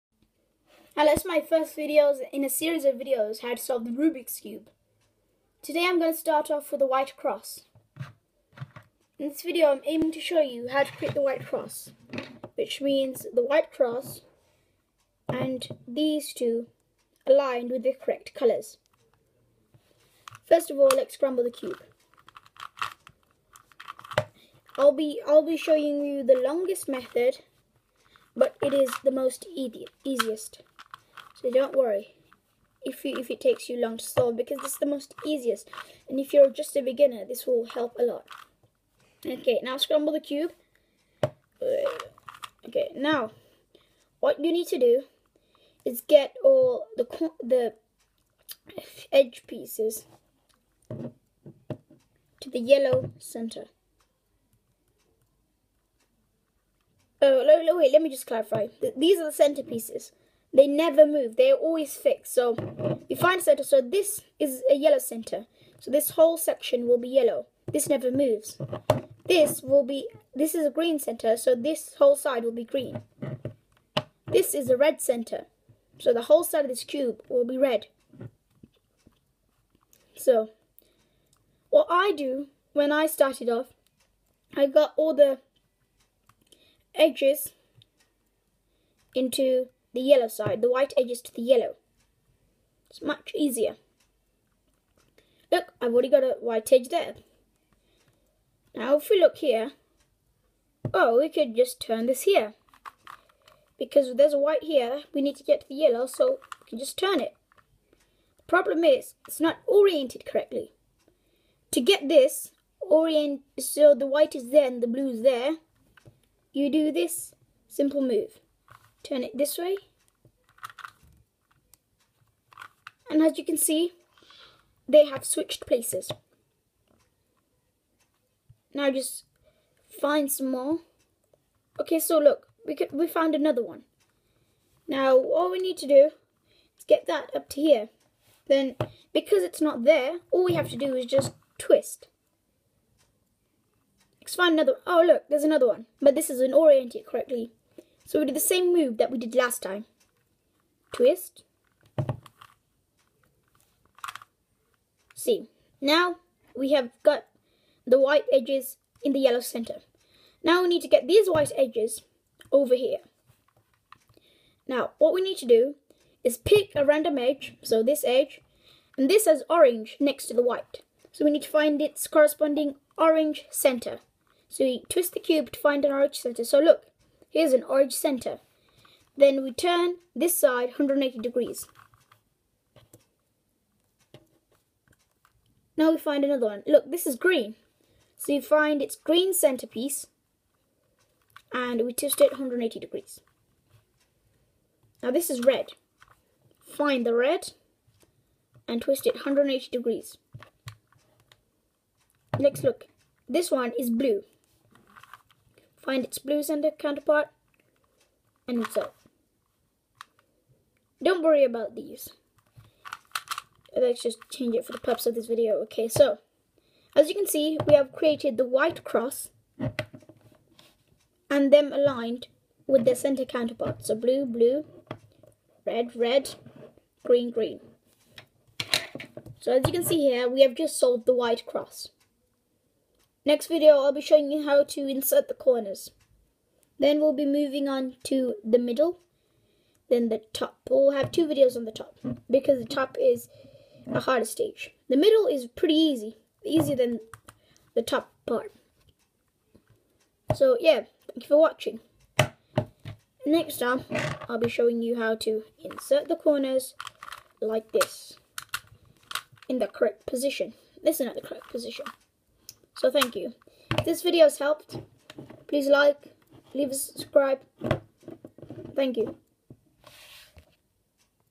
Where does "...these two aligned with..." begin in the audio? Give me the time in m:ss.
0:15.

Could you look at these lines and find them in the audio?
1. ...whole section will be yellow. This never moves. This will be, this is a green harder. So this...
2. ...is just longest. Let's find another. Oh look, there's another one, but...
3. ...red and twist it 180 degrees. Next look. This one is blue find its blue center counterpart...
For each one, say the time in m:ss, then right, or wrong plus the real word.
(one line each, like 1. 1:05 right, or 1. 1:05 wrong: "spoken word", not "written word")
1. 1:06 wrong: "center", not "harder"
2. 2:20 wrong: "twist", not "longest"
3. 3:17 right.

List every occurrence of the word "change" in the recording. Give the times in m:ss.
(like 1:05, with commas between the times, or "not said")
3:34.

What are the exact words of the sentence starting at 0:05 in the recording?
Today I'm going to start off with a white cross.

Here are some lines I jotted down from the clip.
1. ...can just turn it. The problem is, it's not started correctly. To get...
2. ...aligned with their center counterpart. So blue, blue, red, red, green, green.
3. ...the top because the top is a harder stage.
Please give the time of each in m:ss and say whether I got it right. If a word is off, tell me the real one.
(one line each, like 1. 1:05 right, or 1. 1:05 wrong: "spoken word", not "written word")
1. 1:46 wrong: "oriented", not "started"
2. 3:41 right
3. 4:01 right.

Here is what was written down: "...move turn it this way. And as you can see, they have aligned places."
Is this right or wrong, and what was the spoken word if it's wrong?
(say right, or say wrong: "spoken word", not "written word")
wrong: "switched", not "aligned".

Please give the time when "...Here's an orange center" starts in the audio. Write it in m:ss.
2:57.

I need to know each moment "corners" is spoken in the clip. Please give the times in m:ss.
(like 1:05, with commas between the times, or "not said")
3:55, 4:16.